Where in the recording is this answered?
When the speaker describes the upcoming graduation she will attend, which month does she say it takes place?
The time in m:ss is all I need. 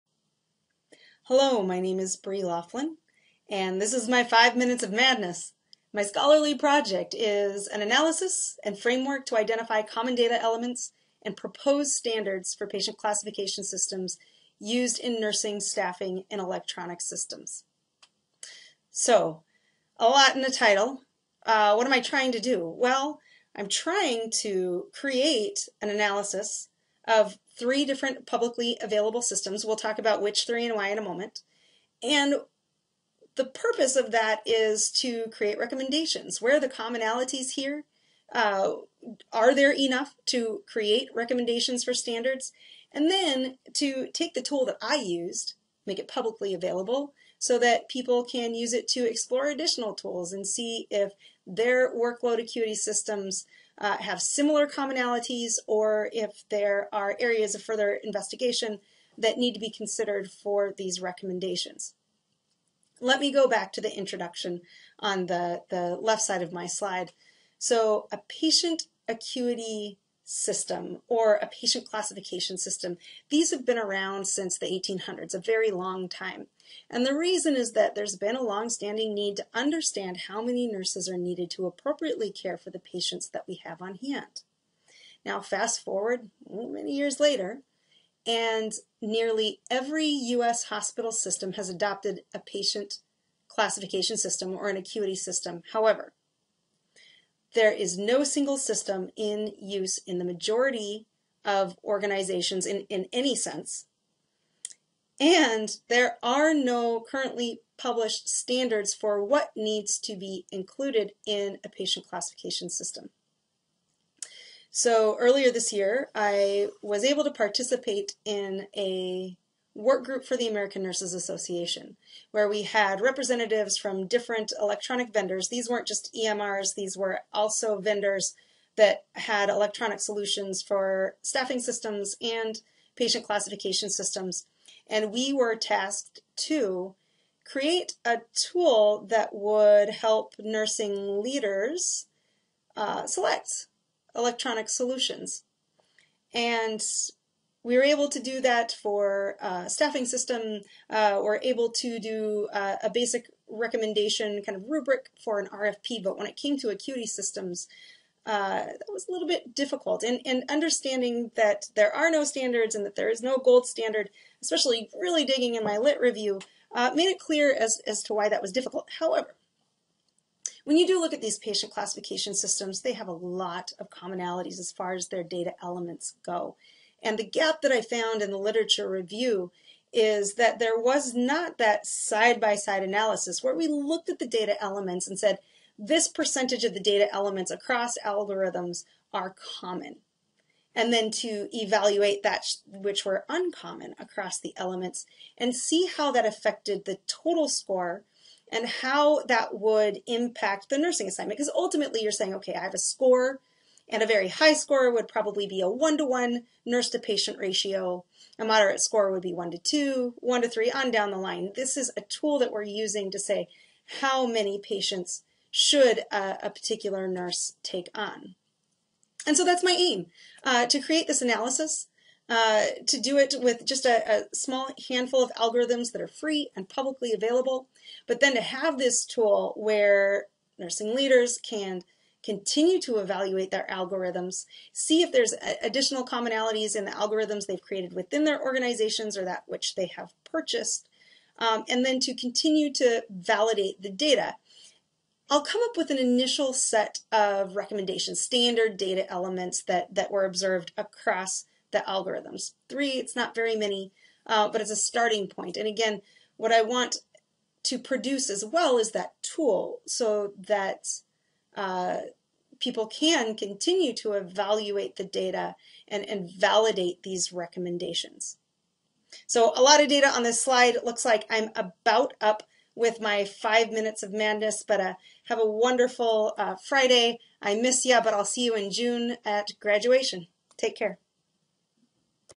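4:38.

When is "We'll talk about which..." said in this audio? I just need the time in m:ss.
0:29.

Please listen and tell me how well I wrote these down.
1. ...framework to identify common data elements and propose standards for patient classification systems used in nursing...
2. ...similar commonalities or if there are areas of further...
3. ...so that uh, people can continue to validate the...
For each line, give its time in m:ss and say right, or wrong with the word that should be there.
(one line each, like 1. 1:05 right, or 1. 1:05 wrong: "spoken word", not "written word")
1. 0:08 right
2. 0:54 right
3. 4:19 wrong: "evaluate", not "validate".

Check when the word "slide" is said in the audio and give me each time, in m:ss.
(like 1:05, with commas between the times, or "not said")
1:06, 4:30.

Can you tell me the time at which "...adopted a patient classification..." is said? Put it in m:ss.
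1:31.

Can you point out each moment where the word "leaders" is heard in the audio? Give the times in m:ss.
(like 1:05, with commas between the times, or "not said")
2:21, 3:50.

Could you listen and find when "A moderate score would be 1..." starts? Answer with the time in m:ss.
3:28.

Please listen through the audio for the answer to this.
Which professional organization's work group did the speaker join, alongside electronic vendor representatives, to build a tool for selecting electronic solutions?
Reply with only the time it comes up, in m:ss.
2:00.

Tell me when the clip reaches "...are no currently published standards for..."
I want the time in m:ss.
1:46.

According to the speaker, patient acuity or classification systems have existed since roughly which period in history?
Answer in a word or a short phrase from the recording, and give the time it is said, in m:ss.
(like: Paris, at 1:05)
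the 1800s, at 1:14.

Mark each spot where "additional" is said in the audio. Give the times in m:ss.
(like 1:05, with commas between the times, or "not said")
0:49, 3:55.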